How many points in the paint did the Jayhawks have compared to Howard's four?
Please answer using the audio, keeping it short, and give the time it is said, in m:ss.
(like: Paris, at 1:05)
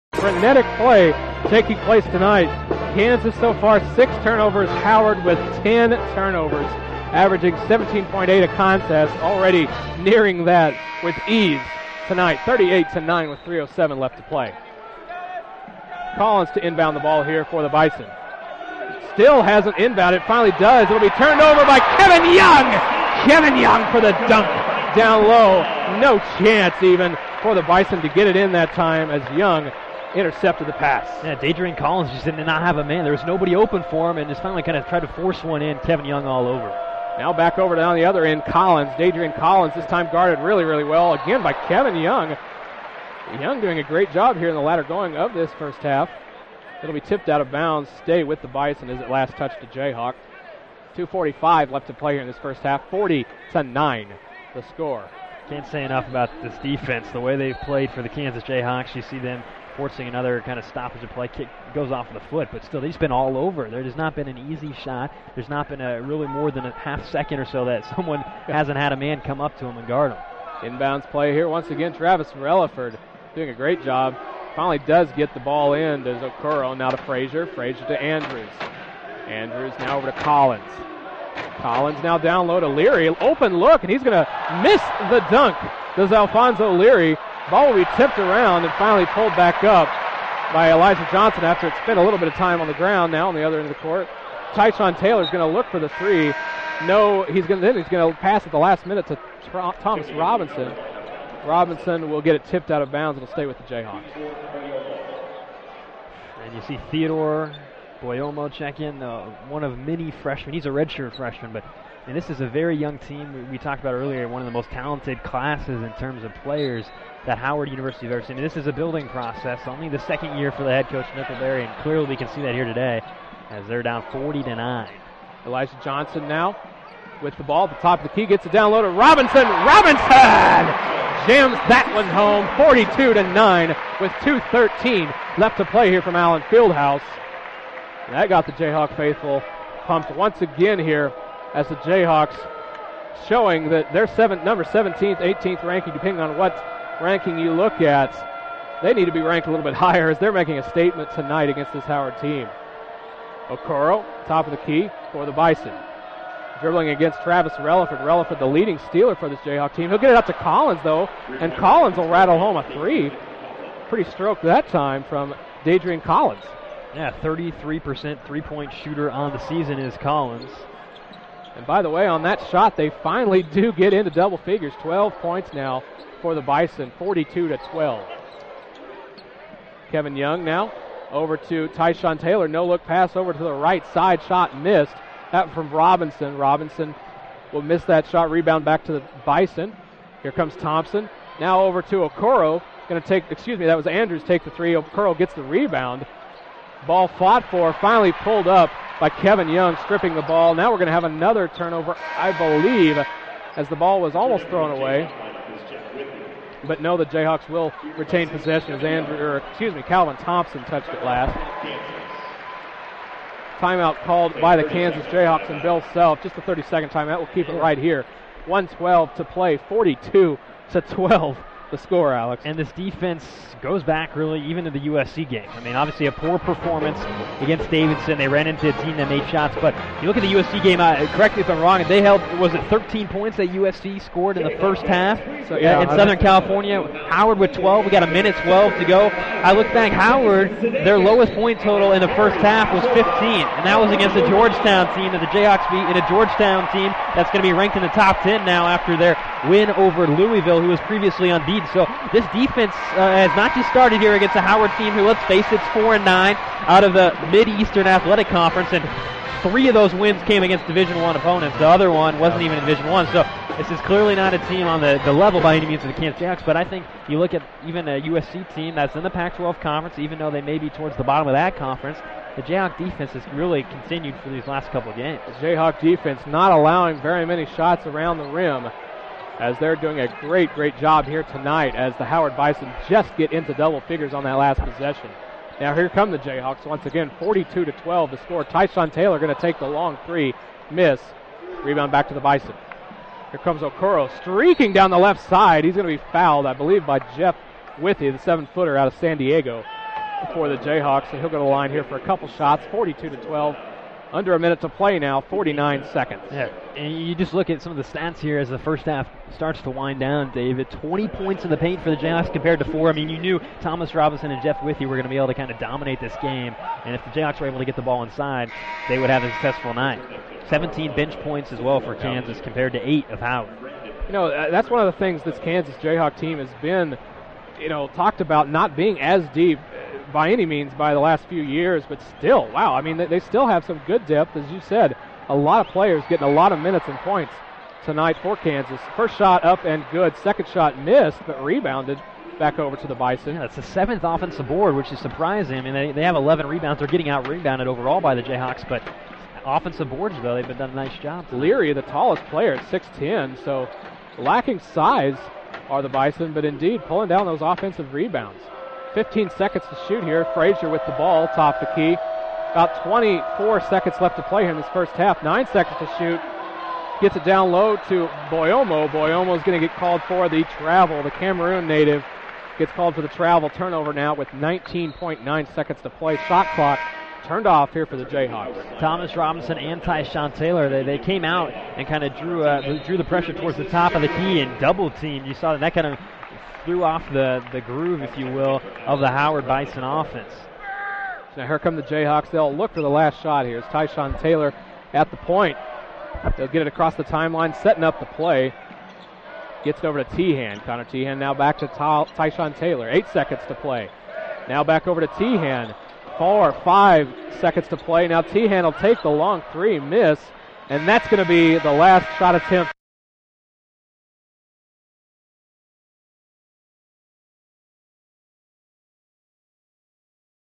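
20, at 5:10.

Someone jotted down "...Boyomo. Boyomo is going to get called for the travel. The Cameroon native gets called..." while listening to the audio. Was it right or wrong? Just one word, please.
right.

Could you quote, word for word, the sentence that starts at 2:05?
Elijah Johnson now with the ball at the top of the key gets it down low to Robinson.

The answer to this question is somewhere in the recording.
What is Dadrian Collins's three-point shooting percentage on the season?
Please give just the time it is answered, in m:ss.
2:47.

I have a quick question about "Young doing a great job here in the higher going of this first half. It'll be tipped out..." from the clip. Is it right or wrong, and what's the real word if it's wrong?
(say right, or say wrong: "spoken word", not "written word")
wrong: "latter", not "higher".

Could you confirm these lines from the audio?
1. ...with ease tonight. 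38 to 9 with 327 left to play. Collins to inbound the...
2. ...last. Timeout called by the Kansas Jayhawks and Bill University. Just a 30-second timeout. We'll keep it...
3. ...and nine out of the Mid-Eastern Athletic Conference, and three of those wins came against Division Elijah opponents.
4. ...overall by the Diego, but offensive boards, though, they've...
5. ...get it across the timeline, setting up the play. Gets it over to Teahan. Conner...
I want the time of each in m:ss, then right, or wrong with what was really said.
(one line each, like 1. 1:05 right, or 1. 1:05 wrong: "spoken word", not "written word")
1. 0:11 wrong: "307", not "327"
2. 3:31 wrong: "Self", not "University"
3. 4:15 wrong: "One", not "Elijah"
4. 5:47 wrong: "Jayhawks", not "Diego"
5. 6:36 right.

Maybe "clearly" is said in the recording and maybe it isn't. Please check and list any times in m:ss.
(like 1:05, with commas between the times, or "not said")
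2:01, 4:23.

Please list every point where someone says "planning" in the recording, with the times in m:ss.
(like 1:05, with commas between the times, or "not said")
not said.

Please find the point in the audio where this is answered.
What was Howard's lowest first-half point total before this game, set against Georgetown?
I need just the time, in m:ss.
4:00.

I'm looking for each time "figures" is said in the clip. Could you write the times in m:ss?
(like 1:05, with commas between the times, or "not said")
2:54, 4:43.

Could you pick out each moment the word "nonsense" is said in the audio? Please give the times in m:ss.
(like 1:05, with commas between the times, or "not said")
not said.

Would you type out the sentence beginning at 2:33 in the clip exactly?
Okoro, top of the key for the Bison.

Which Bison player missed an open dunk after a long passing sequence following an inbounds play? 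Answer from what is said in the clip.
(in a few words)
Alfonso Leary.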